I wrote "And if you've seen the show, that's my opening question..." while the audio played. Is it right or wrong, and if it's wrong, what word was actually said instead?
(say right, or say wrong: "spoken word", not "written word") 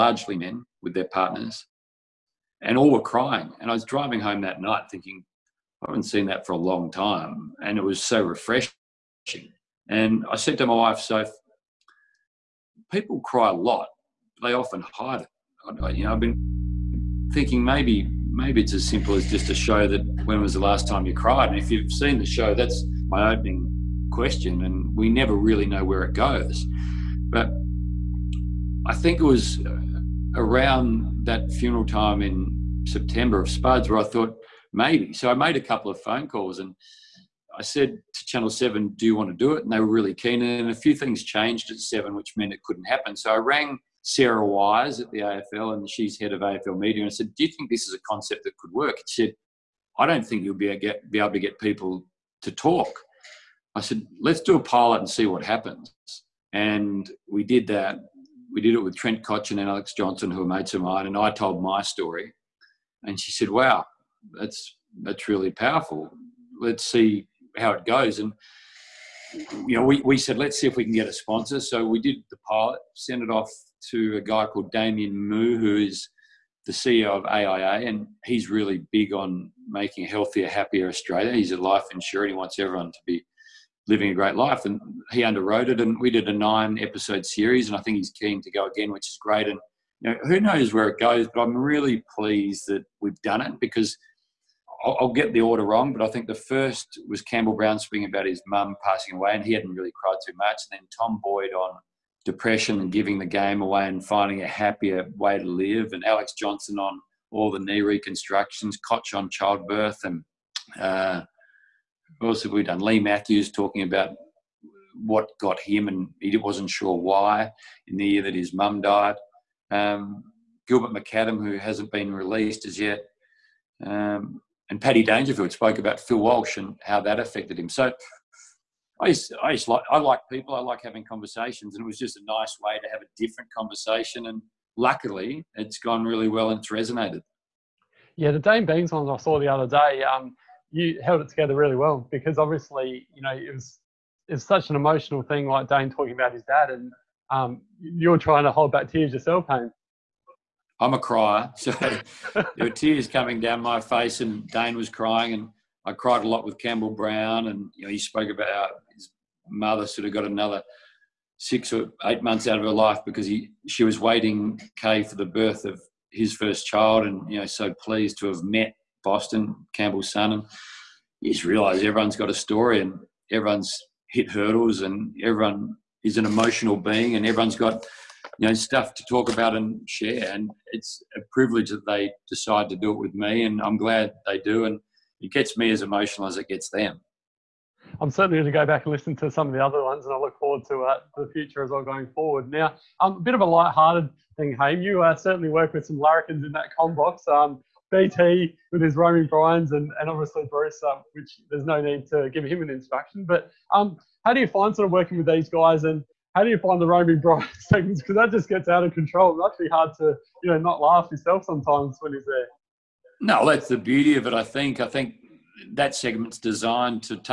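right.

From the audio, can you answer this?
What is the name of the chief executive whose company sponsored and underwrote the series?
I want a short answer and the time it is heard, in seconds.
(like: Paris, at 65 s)
Damien Mu, at 74 s.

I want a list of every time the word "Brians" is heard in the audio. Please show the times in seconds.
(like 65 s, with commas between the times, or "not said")
199 s, 207 s.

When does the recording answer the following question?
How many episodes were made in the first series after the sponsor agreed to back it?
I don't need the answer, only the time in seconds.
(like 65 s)
86 s.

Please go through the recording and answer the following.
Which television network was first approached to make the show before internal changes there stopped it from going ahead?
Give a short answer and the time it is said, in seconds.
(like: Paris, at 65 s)
Channel 7, at 38 s.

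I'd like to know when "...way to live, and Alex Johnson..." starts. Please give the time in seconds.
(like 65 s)
105 s.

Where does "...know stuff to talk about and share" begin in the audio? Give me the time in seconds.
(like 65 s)
178 s.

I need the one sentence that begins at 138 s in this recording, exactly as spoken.
Yeah, the Dayne Beams one I saw the other day.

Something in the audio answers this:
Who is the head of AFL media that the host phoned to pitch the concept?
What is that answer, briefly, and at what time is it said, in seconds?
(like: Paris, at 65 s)
Sarah Wise, at 44 s.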